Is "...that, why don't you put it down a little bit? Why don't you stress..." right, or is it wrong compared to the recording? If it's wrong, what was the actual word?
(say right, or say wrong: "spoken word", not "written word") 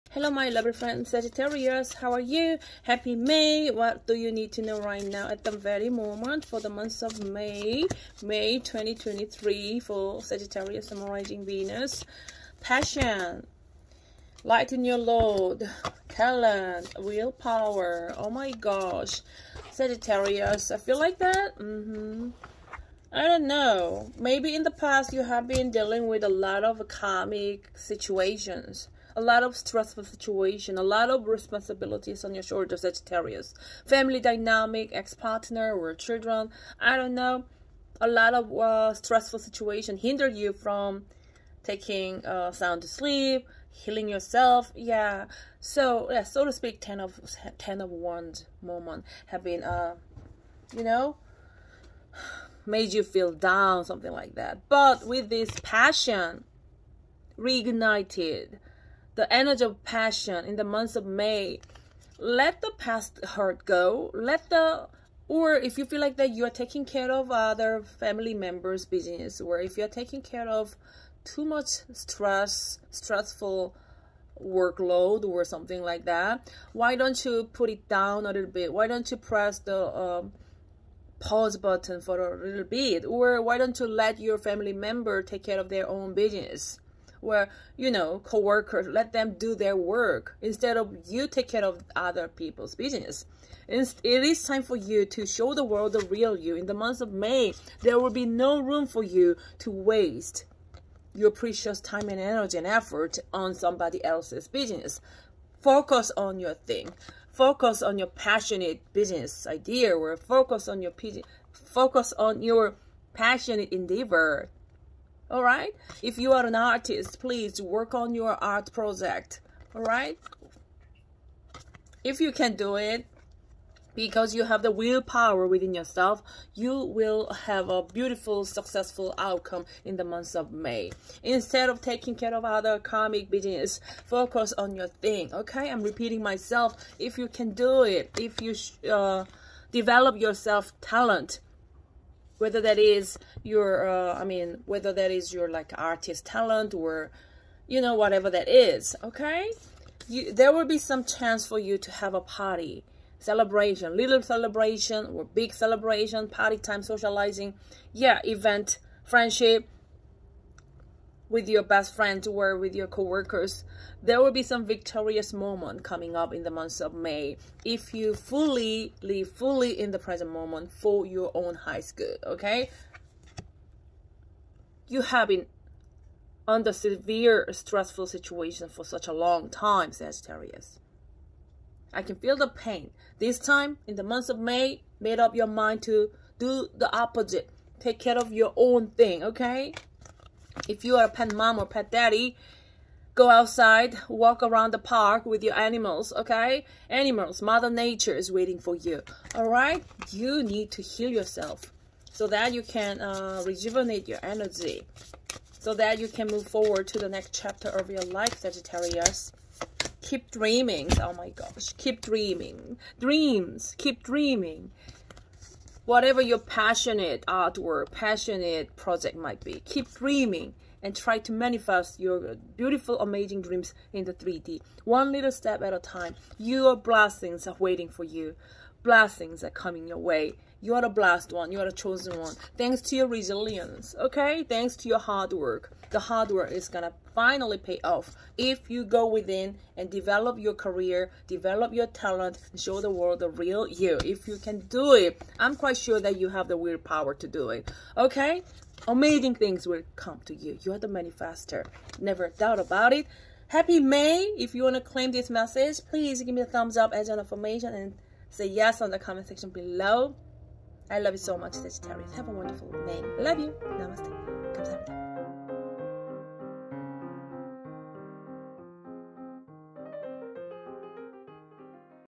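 wrong: "press", not "stress".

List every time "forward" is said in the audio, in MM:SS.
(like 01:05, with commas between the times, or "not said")
03:26.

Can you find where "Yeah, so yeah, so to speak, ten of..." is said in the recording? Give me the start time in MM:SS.
00:44.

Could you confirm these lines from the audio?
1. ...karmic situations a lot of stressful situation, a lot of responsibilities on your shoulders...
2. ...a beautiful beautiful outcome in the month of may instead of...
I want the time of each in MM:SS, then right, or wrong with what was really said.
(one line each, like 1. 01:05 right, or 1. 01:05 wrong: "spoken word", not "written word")
1. 00:26 right
2. 02:07 wrong: "successful", not "beautiful".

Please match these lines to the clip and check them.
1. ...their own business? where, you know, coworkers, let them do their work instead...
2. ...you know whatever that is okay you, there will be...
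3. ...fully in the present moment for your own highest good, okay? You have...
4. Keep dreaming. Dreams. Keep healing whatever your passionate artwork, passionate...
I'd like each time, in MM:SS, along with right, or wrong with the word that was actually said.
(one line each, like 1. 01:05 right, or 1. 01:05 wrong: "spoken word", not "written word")
1. 01:25 right
2. 02:27 right
3. 02:49 right
4. 03:31 wrong: "dreaming", not "healing".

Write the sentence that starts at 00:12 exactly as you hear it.
Passion, light in your load, talent, willpower, oh my gosh, Sagittarius, I feel like that?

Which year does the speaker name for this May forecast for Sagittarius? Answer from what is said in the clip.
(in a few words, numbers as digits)
2023.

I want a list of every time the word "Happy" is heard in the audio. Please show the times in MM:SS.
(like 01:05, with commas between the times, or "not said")
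00:02, 04:13.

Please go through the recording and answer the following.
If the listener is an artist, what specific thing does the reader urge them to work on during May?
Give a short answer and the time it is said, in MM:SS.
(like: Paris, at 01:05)
Art project, at 01:58.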